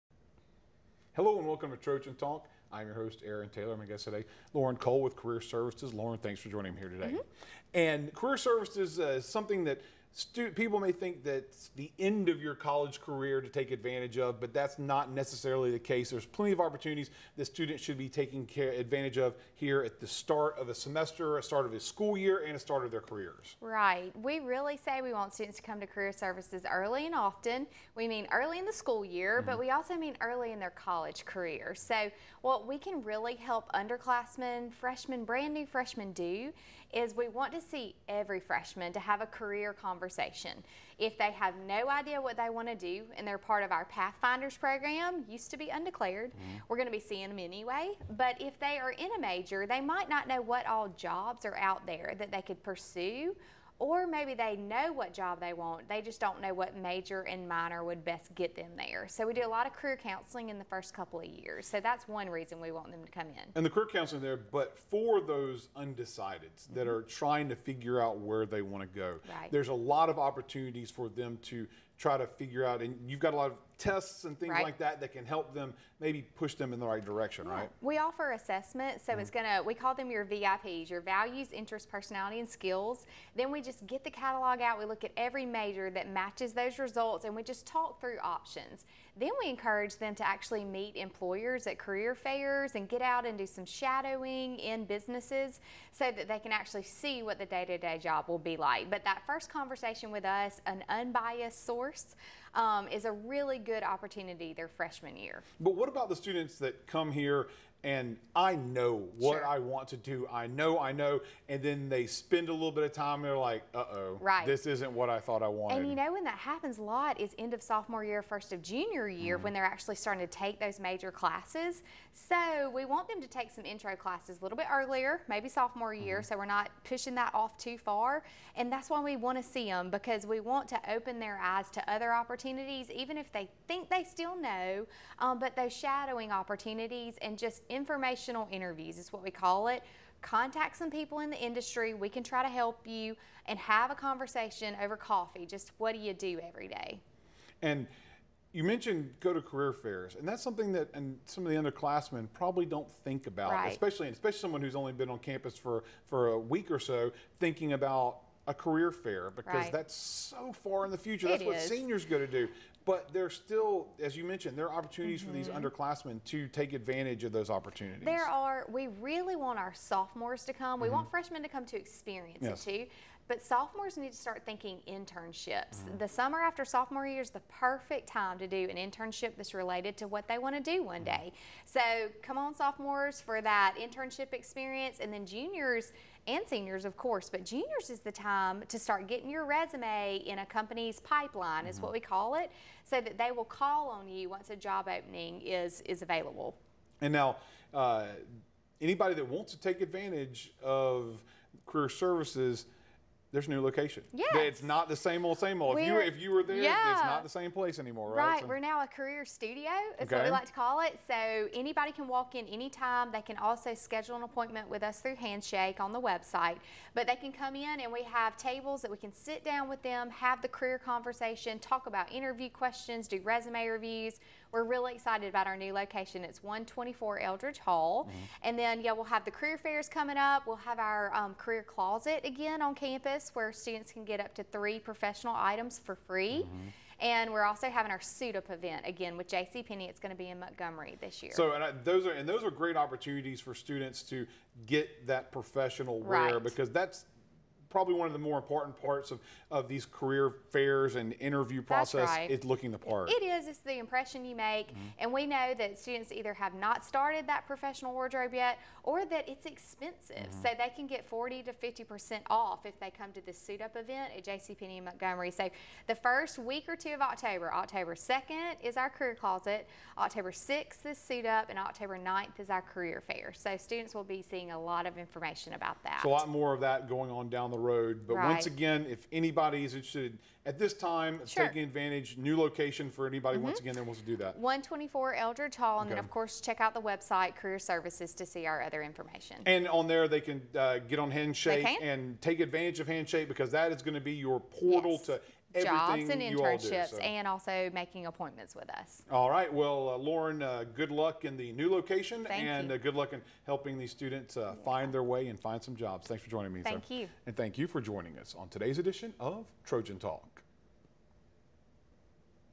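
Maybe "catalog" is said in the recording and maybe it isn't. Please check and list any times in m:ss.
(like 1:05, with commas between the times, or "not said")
1:24.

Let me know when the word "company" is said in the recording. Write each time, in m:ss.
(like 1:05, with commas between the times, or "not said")
3:10.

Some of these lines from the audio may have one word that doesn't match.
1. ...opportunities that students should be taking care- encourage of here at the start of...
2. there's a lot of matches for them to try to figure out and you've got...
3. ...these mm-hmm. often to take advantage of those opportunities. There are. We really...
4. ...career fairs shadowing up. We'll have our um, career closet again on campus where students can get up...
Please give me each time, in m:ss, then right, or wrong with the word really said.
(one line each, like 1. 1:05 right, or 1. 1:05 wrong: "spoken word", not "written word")
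1. 0:16 wrong: "advantage", not "encourage"
2. 1:09 wrong: "opportunities", not "matches"
3. 2:45 wrong: "underclassmen", not "often"
4. 3:49 wrong: "coming", not "shadowing".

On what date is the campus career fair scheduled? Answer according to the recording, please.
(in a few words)
October 9th.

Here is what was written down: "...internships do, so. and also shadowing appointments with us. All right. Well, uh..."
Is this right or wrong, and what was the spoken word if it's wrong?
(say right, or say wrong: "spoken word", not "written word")
wrong: "making", not "shadowing".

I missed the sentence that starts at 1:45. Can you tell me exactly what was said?
But what about the students that come here and I know what sure.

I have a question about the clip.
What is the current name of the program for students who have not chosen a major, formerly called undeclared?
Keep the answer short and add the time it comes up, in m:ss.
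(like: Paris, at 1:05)
Pathfinders, at 0:43.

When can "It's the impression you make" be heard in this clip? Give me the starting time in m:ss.
4:13.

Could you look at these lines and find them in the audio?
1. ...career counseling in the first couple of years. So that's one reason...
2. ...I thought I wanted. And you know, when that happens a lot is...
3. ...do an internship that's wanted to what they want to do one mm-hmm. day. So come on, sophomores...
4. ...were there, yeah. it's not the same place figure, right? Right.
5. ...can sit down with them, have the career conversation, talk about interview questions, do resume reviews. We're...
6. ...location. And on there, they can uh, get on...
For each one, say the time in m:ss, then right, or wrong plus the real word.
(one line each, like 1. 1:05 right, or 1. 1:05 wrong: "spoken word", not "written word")
1. 0:59 right
2. 1:55 right
3. 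2:58 wrong: "related", not "wanted"
4. 3:26 wrong: "anymore", not "figure"
5. 3:38 right
6. 4:48 wrong: "information", not "location".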